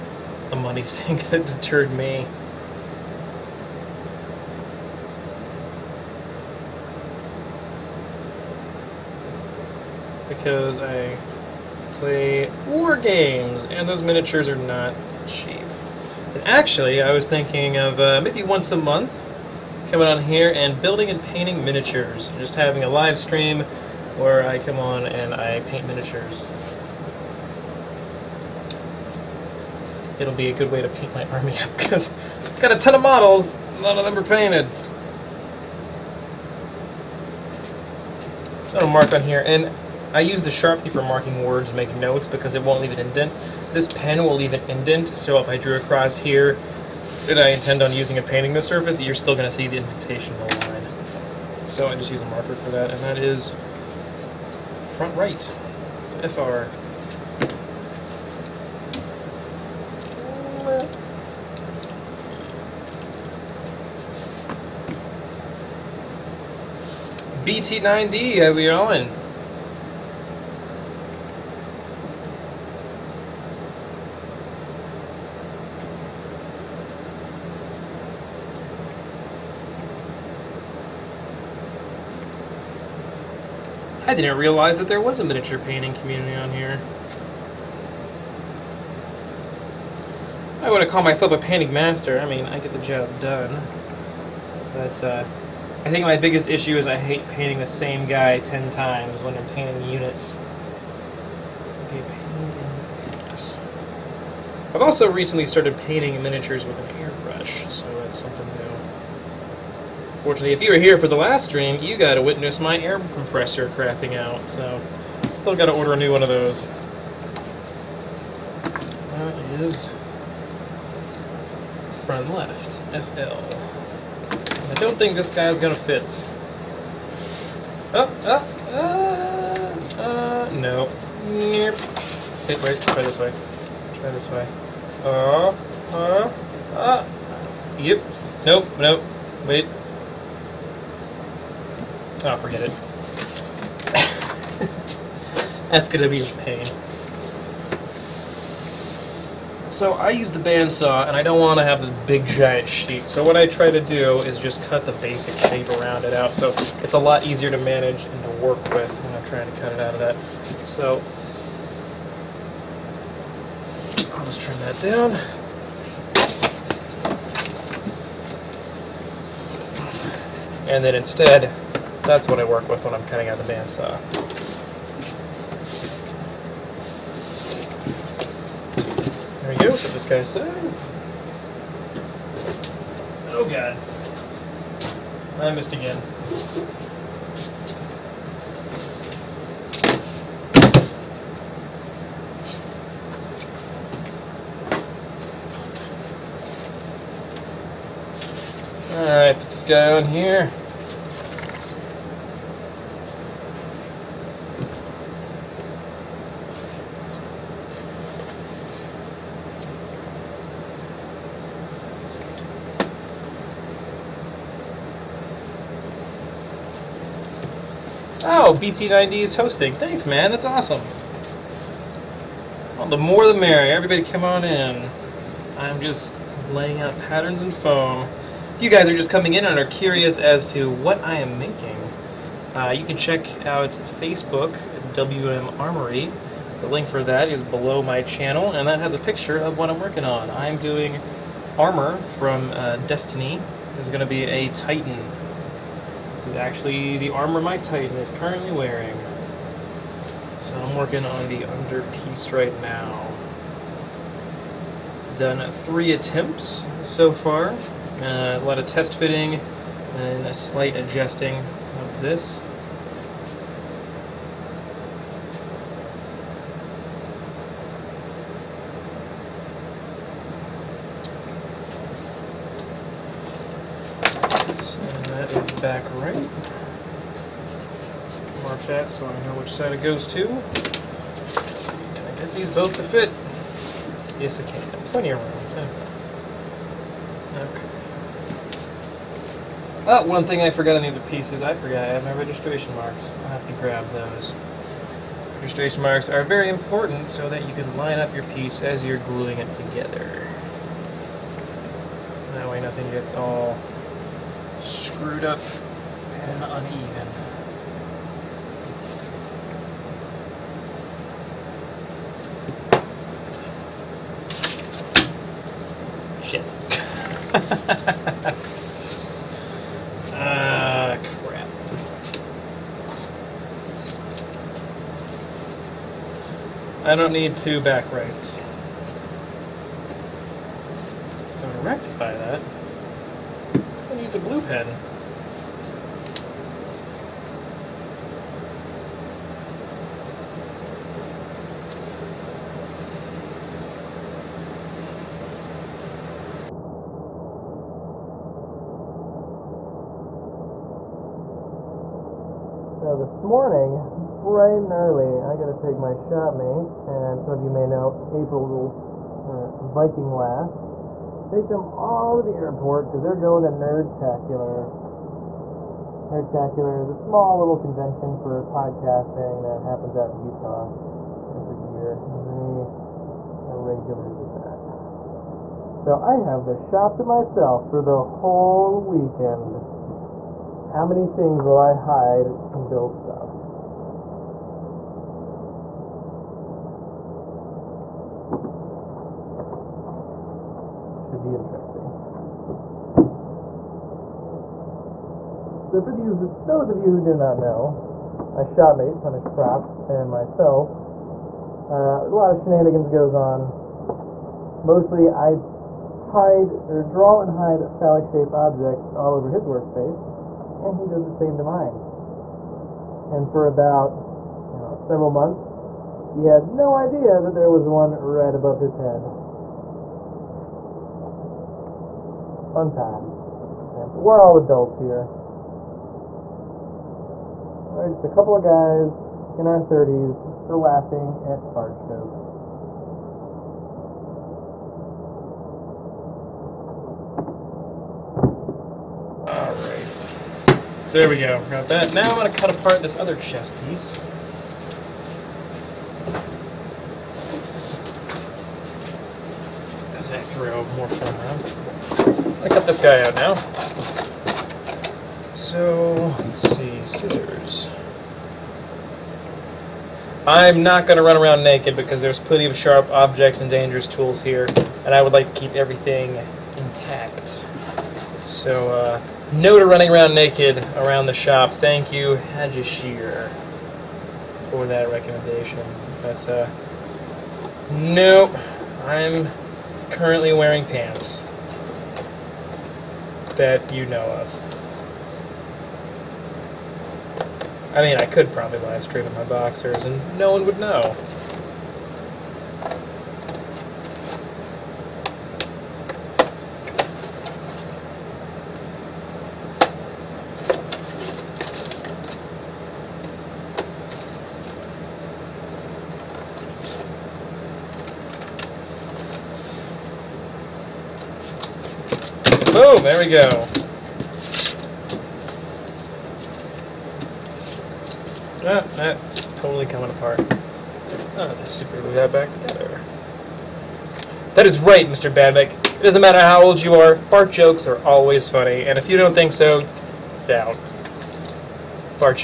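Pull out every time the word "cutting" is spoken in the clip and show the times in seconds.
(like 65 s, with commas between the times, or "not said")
173 s.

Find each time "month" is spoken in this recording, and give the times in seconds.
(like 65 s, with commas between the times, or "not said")
18 s, 415 s.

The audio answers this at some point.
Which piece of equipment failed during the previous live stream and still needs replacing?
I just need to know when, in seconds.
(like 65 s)
112 s.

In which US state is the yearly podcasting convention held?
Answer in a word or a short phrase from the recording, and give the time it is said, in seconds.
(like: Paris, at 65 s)
Utah, at 370 s.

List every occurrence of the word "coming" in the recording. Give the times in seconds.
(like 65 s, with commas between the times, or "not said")
19 s, 229 s, 519 s.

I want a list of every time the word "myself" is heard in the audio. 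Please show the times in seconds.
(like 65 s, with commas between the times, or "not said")
91 s, 377 s, 400 s.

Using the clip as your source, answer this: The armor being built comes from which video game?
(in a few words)
Destiny.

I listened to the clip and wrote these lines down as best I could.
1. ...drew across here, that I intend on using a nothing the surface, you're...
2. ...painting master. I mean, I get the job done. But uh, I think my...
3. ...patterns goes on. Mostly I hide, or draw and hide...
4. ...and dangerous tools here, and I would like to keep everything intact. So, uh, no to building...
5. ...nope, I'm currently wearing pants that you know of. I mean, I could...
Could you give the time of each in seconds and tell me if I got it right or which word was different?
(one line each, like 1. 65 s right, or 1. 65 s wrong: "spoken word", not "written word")
1. 45 s wrong: "painting", not "nothing"
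2. 91 s right
3. 402 s wrong: "shenanigans", not "patterns"
4. 463 s wrong: "running", not "building"
5. 477 s right.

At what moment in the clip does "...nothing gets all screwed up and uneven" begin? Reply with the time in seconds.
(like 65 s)
302 s.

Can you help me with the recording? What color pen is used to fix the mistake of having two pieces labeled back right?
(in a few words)
blue.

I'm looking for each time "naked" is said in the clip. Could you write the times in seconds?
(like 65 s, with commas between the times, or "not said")
461 s, 470 s.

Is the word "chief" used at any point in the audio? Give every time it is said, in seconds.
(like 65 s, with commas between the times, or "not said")
not said.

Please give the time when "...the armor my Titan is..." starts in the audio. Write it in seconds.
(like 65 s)
246 s.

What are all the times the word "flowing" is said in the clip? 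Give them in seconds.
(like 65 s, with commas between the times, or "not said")
not said.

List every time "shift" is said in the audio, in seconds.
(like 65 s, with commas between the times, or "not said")
not said.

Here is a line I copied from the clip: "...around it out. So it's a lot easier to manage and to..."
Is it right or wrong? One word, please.
right.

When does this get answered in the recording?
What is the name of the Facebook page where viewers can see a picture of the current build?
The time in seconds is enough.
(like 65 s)
234 s.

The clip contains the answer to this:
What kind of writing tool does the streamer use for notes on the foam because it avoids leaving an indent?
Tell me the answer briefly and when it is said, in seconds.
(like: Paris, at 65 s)
Sharpie, at 40 s.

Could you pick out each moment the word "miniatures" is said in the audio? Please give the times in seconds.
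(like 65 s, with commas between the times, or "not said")
14 s, 21 s, 25 s, 85 s, 106 s.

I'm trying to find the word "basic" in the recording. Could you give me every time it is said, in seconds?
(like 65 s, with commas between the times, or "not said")
154 s.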